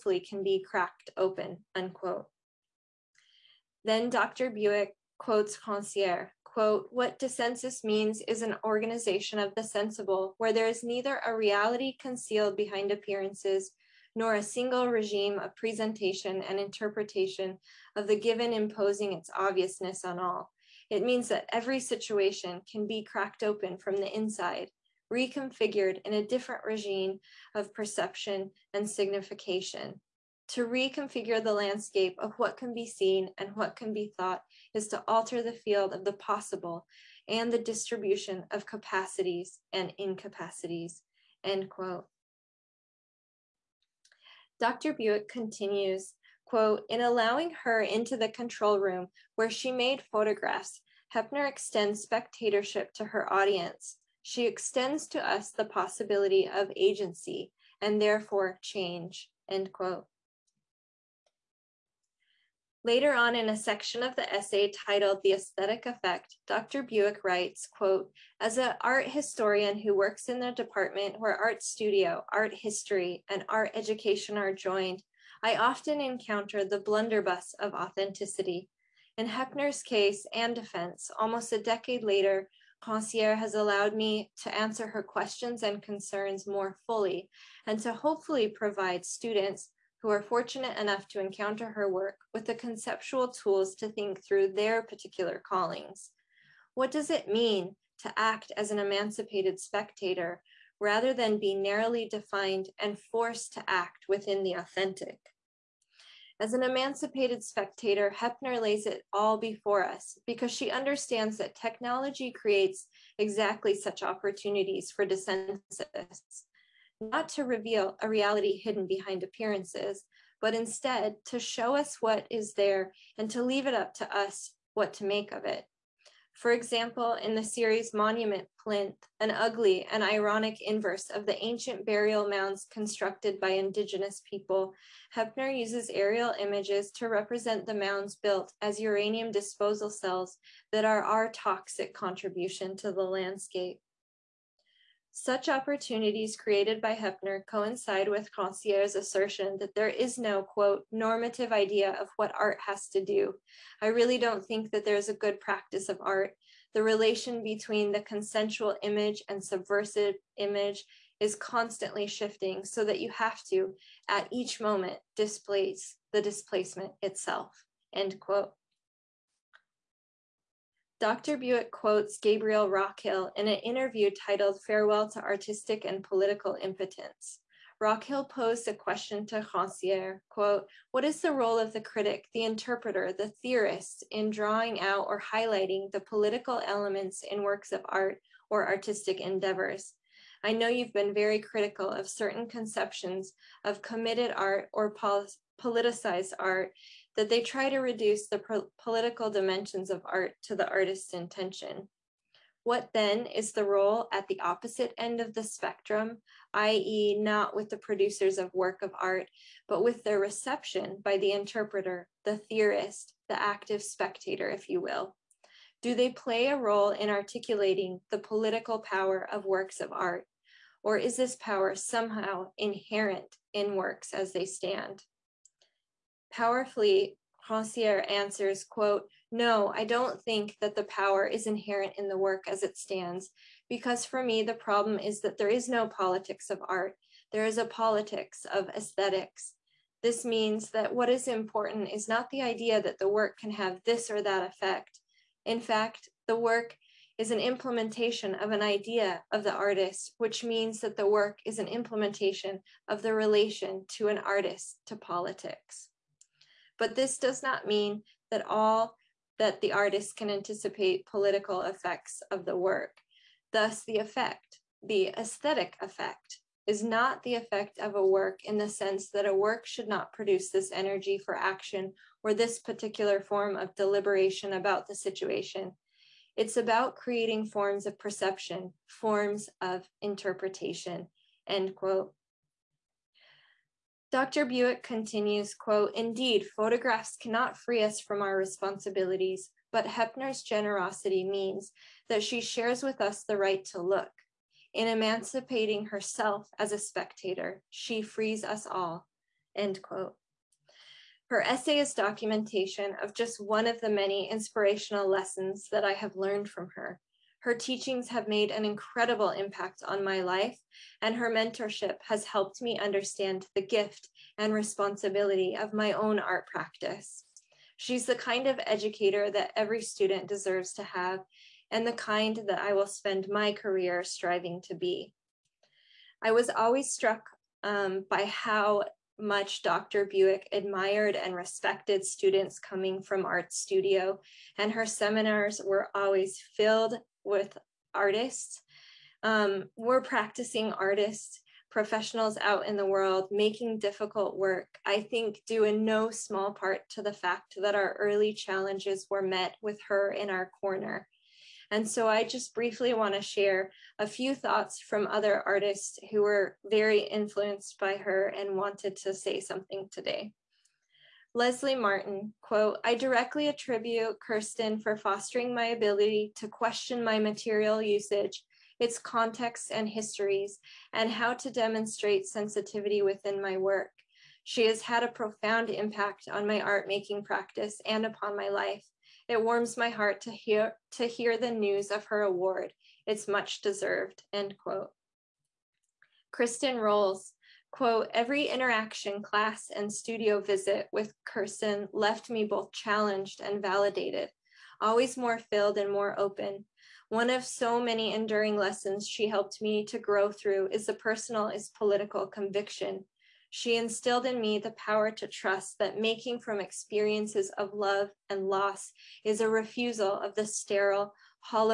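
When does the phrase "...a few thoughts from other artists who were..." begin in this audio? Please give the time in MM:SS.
05:53.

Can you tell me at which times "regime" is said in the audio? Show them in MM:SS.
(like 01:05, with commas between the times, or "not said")
00:14, 00:26.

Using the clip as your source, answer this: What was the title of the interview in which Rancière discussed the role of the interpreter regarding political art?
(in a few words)
Farewell to Artistic and Political Impotence.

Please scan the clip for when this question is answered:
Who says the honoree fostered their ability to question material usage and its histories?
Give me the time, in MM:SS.
06:01.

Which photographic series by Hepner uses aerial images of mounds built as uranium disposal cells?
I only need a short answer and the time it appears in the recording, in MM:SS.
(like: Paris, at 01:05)
Monument Plinth, at 02:07.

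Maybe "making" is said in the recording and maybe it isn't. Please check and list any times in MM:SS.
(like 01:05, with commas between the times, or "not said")
05:43, 06:16, 06:46.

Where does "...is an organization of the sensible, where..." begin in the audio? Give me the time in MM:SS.
00:08.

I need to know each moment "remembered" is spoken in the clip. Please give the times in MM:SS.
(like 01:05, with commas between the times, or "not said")
not said.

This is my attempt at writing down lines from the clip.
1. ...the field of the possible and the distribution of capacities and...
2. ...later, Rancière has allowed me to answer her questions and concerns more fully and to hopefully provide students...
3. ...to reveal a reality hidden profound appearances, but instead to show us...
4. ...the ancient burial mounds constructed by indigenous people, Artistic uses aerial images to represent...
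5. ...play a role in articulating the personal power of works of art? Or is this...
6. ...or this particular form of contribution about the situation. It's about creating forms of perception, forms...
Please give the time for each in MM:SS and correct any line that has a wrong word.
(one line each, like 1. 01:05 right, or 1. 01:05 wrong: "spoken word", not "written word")
1. 00:35 right
2. 01:22 right
3. 01:57 wrong: "behind", not "profound"
4. 02:11 wrong: "Hepner", not "Artistic"
5. 03:36 wrong: "political", not "personal"
6. 04:32 wrong: "deliberation", not "contribution".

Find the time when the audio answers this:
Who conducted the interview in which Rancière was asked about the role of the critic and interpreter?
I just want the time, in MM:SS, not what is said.
02:52.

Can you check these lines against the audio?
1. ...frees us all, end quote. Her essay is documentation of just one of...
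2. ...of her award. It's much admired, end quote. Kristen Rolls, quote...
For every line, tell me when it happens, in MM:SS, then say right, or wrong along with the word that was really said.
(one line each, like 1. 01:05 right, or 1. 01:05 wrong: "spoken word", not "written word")
1. 04:58 right
2. 06:21 wrong: "deserved", not "admired".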